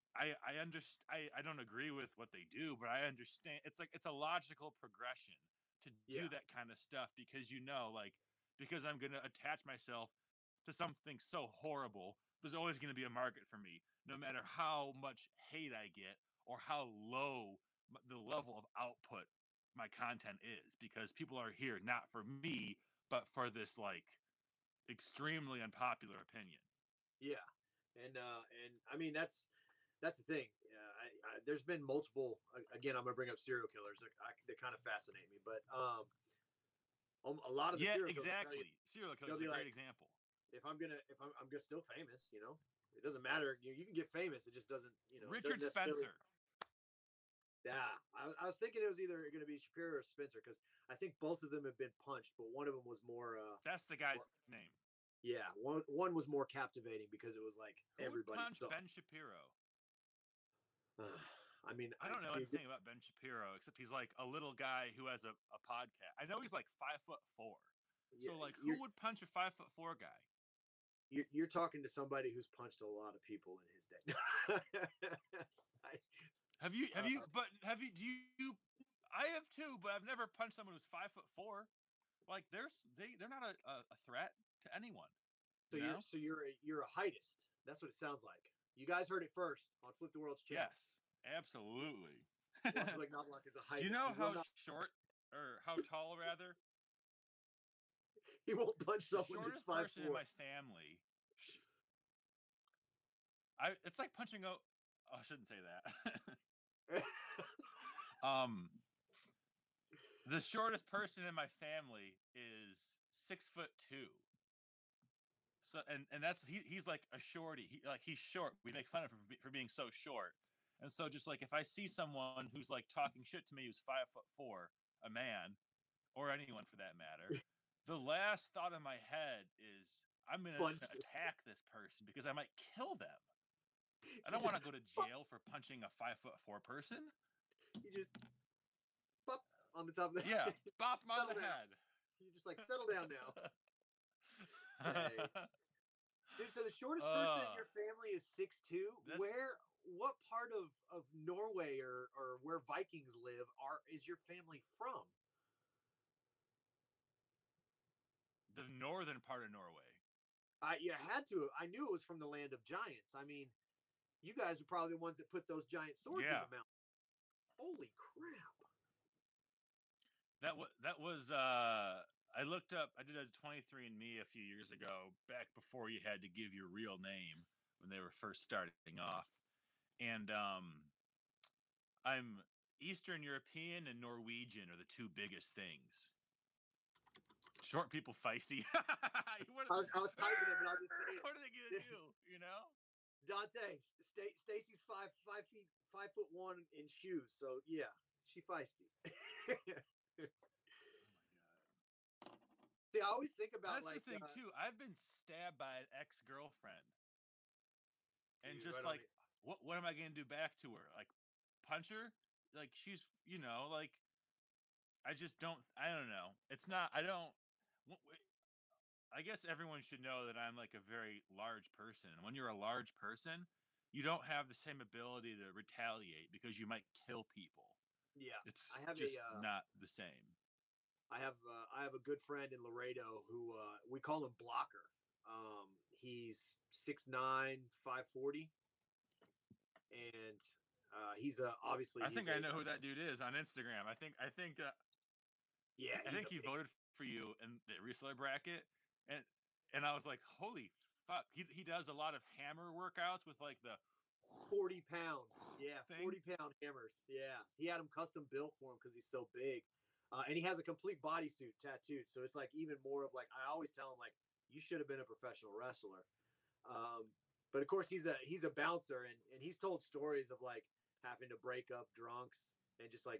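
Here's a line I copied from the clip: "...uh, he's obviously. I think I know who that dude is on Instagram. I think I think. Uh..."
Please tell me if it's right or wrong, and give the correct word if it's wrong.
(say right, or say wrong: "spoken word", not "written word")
right.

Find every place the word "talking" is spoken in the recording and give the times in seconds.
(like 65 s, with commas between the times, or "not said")
71 s, 122 s.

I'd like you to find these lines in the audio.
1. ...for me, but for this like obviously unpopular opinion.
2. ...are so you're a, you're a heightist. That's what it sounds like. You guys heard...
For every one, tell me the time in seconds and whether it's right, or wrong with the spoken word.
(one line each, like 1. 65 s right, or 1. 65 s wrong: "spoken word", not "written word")
1. 22 s wrong: "extremely", not "obviously"
2. 85 s right.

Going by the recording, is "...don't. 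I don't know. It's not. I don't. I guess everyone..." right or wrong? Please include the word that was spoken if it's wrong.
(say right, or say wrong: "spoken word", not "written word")
right.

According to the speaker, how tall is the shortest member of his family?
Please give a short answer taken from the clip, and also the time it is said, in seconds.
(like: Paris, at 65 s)
6'2", at 113 s.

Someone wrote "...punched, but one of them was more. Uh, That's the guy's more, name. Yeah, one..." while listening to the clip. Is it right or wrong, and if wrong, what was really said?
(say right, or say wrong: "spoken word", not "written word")
right.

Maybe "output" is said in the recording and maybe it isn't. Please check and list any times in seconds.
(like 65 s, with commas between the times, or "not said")
18 s.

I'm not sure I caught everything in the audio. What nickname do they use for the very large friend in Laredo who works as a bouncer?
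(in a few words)
Blocker.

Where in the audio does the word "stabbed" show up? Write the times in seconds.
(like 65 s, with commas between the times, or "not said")
204 s.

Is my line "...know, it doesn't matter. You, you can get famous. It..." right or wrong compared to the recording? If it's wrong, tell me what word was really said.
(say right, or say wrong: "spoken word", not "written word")
right.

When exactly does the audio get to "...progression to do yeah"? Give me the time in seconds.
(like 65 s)
4 s.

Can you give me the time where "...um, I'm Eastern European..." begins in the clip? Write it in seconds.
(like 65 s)
180 s.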